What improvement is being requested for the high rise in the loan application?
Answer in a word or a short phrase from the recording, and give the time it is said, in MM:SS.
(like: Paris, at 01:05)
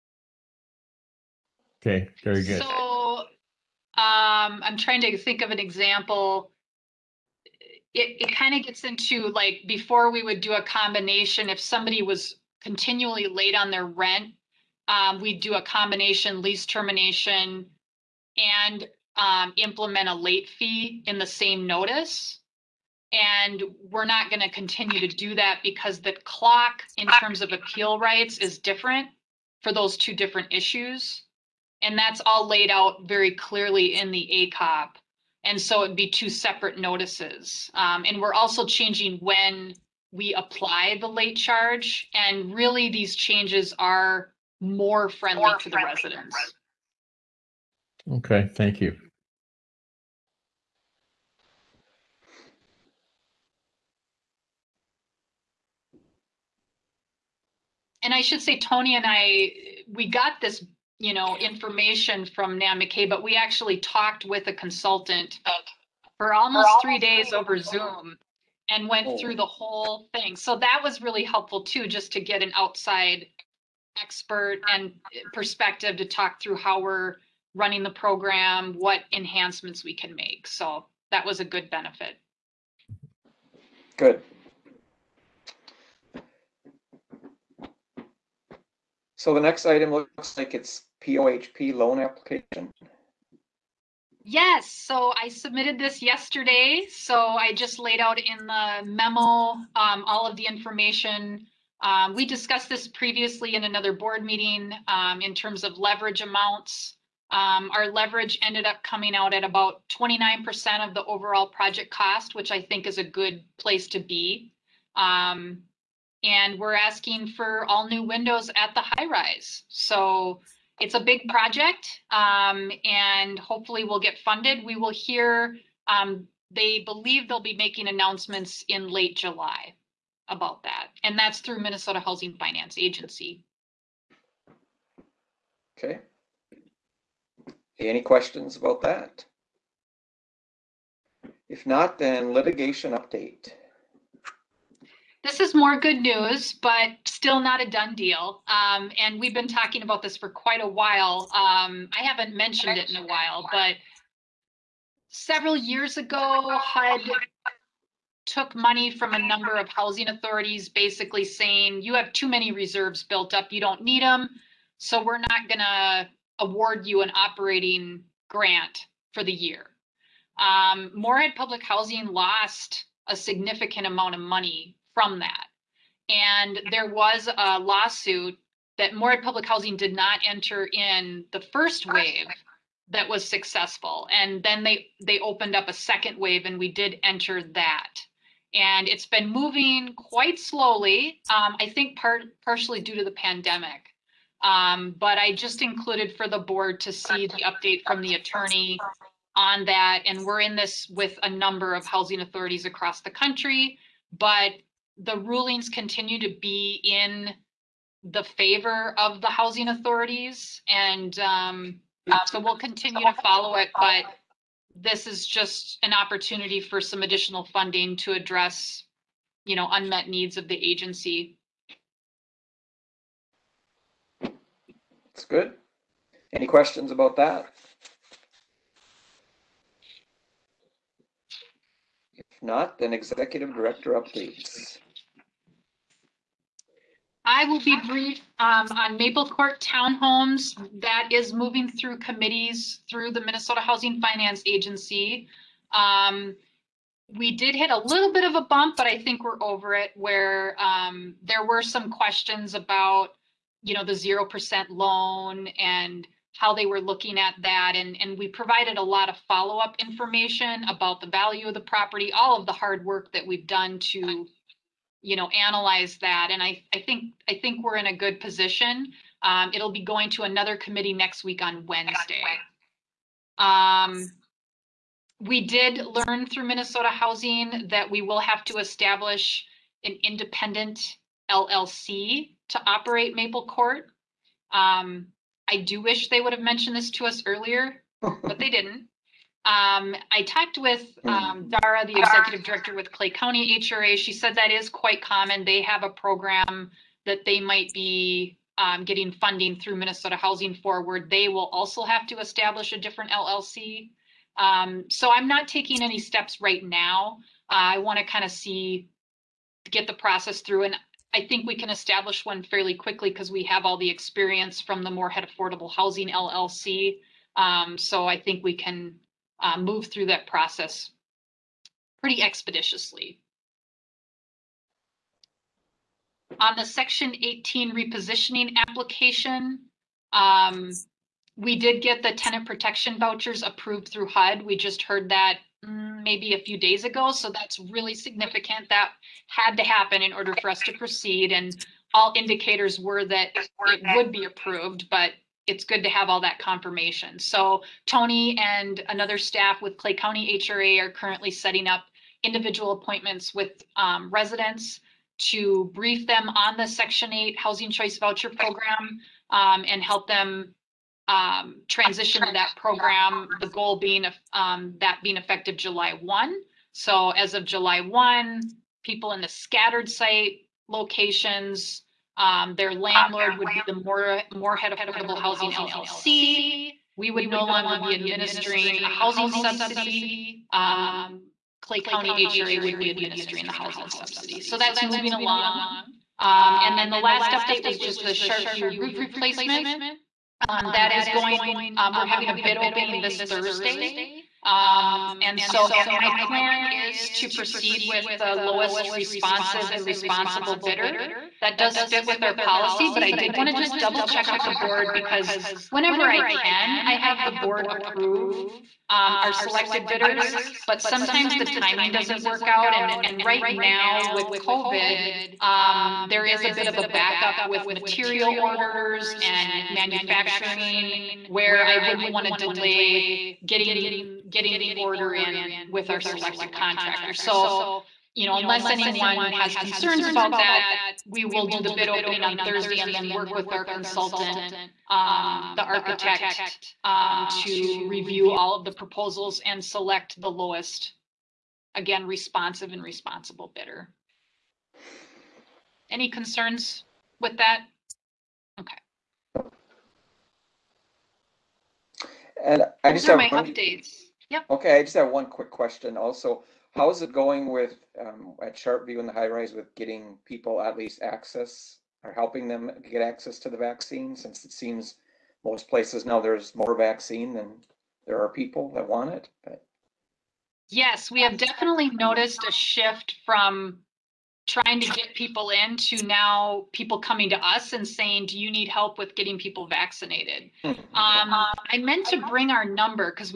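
all new windows, at 01:57.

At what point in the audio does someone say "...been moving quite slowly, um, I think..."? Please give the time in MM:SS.
03:09.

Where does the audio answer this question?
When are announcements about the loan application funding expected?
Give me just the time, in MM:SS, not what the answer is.
02:08.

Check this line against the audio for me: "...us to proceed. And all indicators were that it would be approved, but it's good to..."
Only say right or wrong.
right.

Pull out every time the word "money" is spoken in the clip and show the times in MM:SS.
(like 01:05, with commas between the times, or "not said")
02:38, 02:54.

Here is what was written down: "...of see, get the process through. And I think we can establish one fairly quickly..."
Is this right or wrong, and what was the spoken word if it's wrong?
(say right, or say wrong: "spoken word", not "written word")
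right.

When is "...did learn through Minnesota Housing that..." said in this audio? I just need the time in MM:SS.
04:35.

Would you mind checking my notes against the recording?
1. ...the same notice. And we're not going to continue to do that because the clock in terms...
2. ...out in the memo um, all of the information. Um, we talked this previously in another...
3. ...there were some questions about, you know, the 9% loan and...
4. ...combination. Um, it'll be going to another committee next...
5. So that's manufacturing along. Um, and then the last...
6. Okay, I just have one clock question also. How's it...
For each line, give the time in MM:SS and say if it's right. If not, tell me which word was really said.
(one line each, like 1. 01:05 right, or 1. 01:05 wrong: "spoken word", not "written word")
1. 00:21 right
2. 01:37 wrong: "discussed", not "talked"
3. 04:11 wrong: "0", not "9"
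4. 04:28 wrong: "position", not "combination"
5. 06:24 wrong: "moving", not "manufacturing"
6. 07:34 wrong: "quick", not "clock".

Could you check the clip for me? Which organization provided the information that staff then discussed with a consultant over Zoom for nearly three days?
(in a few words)
Nan McKay.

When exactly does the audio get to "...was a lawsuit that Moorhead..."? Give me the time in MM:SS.
02:56.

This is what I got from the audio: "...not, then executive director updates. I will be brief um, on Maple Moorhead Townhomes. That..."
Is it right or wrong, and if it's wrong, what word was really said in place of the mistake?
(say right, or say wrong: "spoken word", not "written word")
wrong: "Court", not "Moorhead".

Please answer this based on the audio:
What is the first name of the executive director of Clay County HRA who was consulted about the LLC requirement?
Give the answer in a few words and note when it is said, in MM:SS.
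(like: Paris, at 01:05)
Dara, at 04:51.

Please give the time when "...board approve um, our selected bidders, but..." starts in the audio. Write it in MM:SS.
06:47.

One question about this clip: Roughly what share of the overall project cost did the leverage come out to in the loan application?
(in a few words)
29%.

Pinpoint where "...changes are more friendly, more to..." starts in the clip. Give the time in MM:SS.
00:43.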